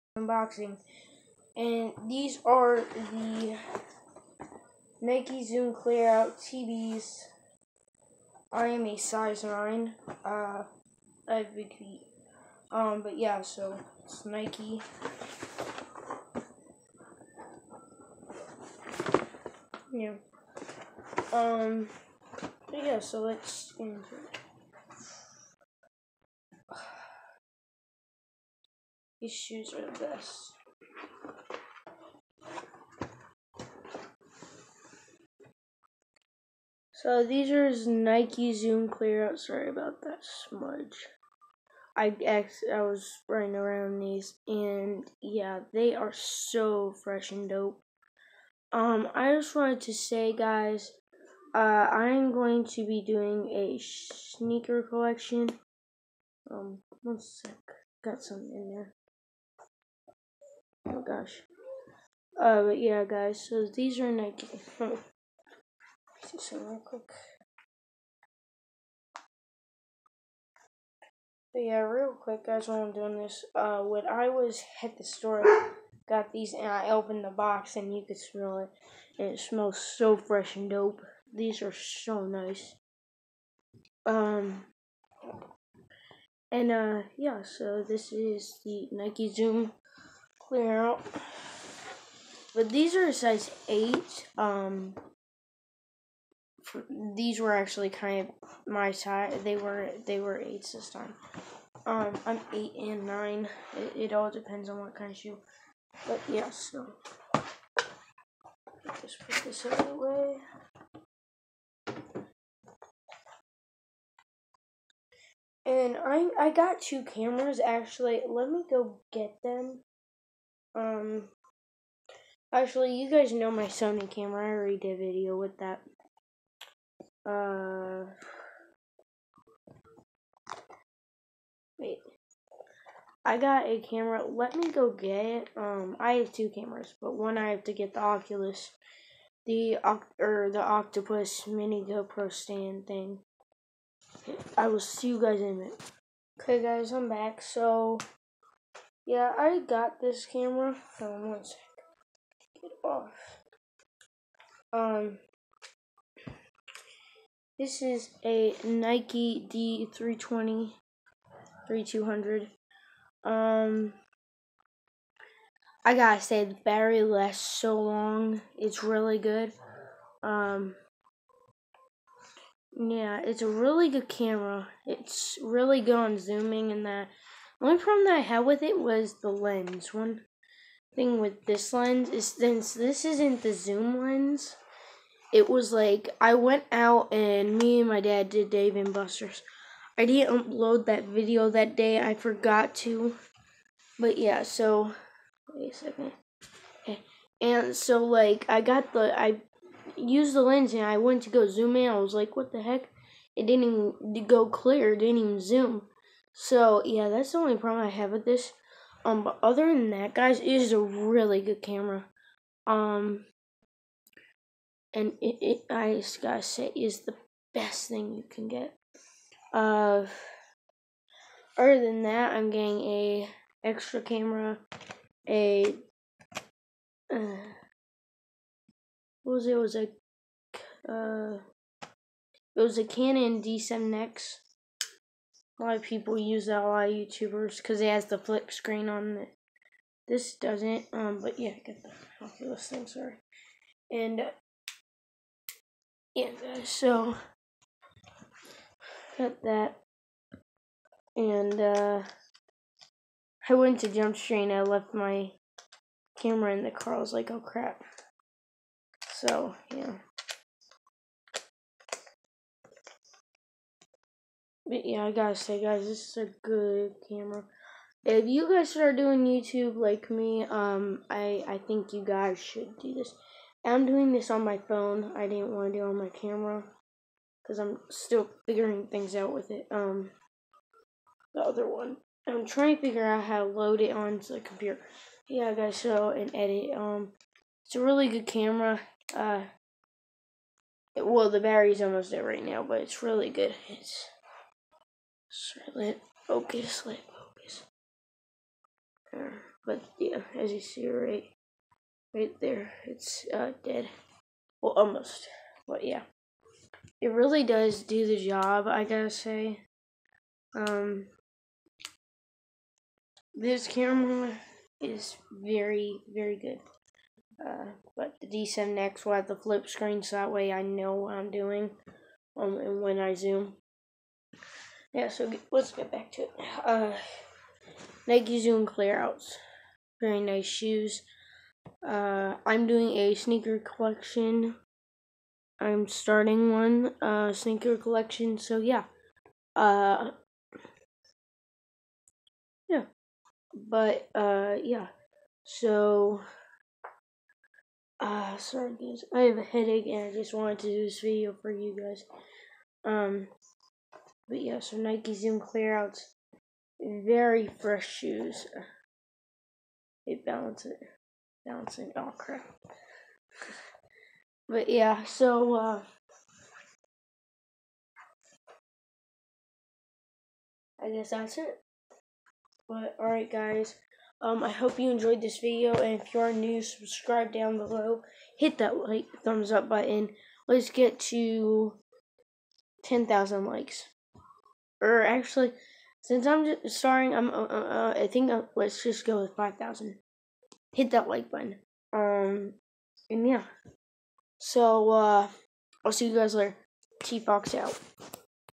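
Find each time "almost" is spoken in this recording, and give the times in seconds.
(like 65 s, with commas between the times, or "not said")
291 s, 304 s.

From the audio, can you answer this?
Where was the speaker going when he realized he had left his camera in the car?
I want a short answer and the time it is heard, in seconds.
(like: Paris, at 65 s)
Jump Street, at 253 s.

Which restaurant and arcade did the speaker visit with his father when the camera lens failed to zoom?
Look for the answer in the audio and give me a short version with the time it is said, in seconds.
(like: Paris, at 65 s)
Dave and Buster's, at 188 s.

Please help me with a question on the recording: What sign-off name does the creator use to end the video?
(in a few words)
T Fox.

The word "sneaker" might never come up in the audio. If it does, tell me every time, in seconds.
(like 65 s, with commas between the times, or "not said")
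53 s, 333 s, 337 s.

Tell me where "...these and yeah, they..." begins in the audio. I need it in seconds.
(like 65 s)
43 s.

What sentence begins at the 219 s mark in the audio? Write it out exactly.
Uh, other than that, I'm getting a extra camera, a uh, what was it?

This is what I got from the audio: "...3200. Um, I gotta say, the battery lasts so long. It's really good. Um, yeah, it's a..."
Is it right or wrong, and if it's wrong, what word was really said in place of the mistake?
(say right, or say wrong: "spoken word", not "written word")
right.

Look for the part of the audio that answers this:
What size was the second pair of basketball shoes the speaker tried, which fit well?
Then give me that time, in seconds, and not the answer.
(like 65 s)
93 s.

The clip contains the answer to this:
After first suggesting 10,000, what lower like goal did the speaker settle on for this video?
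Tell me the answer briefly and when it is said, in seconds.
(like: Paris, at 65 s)
5000, at 389 s.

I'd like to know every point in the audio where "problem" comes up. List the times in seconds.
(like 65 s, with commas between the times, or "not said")
177 s, 207 s.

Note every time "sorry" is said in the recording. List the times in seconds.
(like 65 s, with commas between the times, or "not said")
39 s, 242 s, 348 s.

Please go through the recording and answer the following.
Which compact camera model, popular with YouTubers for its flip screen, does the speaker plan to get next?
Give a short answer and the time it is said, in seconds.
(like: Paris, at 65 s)
Canon G7X, at 232 s.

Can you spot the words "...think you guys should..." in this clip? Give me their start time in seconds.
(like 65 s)
271 s.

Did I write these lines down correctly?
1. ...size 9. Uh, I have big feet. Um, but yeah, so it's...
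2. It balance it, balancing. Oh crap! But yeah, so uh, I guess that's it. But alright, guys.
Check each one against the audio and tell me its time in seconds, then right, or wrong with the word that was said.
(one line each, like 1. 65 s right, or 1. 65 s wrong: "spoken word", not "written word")
1. 8 s right
2. 360 s right.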